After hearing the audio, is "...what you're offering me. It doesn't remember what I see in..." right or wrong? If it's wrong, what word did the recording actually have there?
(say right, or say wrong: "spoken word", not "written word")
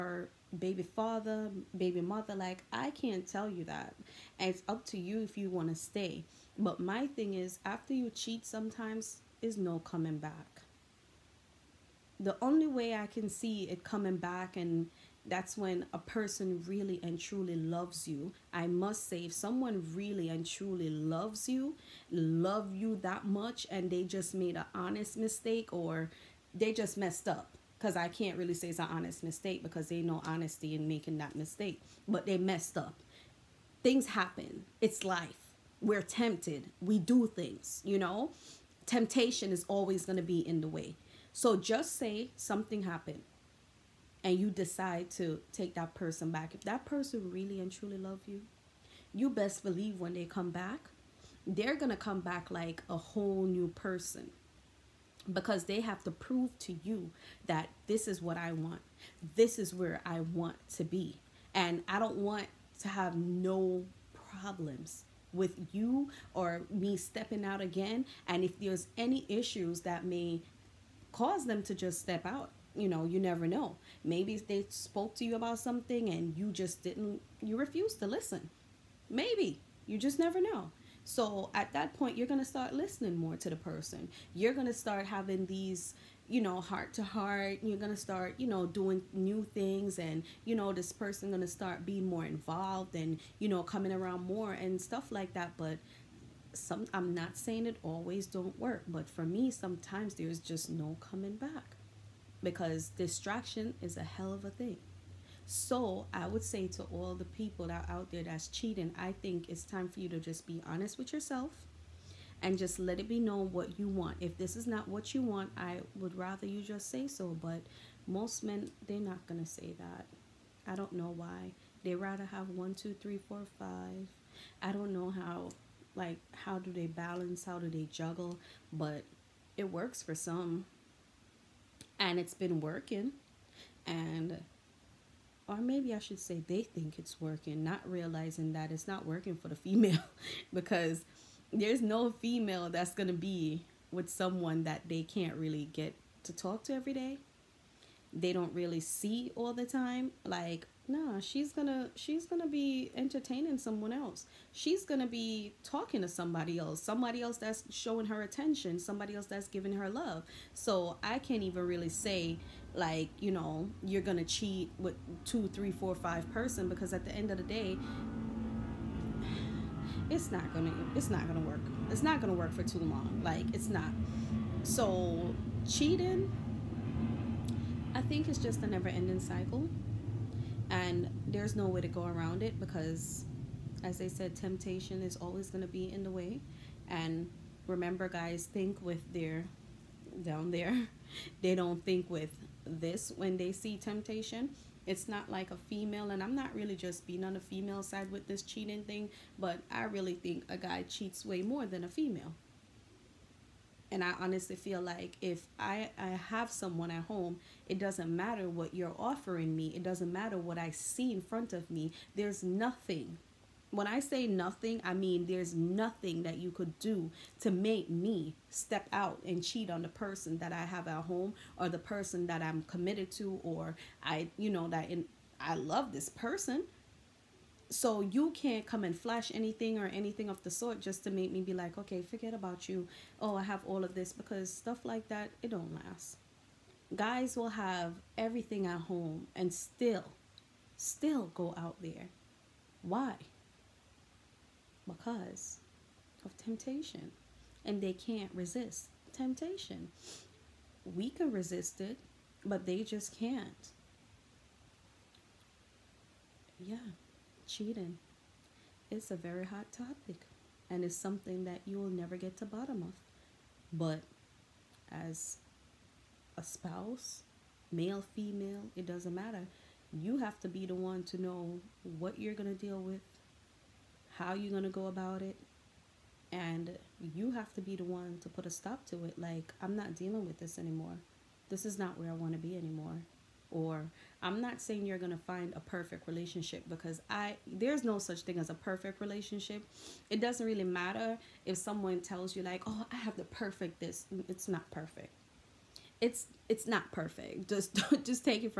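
wrong: "matter", not "remember".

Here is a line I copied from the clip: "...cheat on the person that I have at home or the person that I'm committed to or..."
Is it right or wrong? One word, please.
right.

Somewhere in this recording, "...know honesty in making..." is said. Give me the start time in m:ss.
0:30.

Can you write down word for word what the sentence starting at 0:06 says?
But my thing is after you cheat sometimes is no coming back.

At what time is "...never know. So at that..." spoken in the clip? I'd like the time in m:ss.
1:20.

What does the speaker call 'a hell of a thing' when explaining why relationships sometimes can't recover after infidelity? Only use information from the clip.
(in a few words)
distraction.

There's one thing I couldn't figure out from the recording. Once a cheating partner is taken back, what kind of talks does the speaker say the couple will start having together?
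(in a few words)
heart to heart.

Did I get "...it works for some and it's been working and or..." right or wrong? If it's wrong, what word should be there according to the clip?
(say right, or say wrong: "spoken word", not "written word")
right.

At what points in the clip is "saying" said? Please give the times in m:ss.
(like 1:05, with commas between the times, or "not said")
1:37, 4:44.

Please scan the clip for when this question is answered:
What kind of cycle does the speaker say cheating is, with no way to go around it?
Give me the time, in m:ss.
2:58.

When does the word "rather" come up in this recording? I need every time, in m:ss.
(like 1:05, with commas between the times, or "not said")
1:56, 2:01.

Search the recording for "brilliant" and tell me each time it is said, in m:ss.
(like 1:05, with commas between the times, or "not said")
not said.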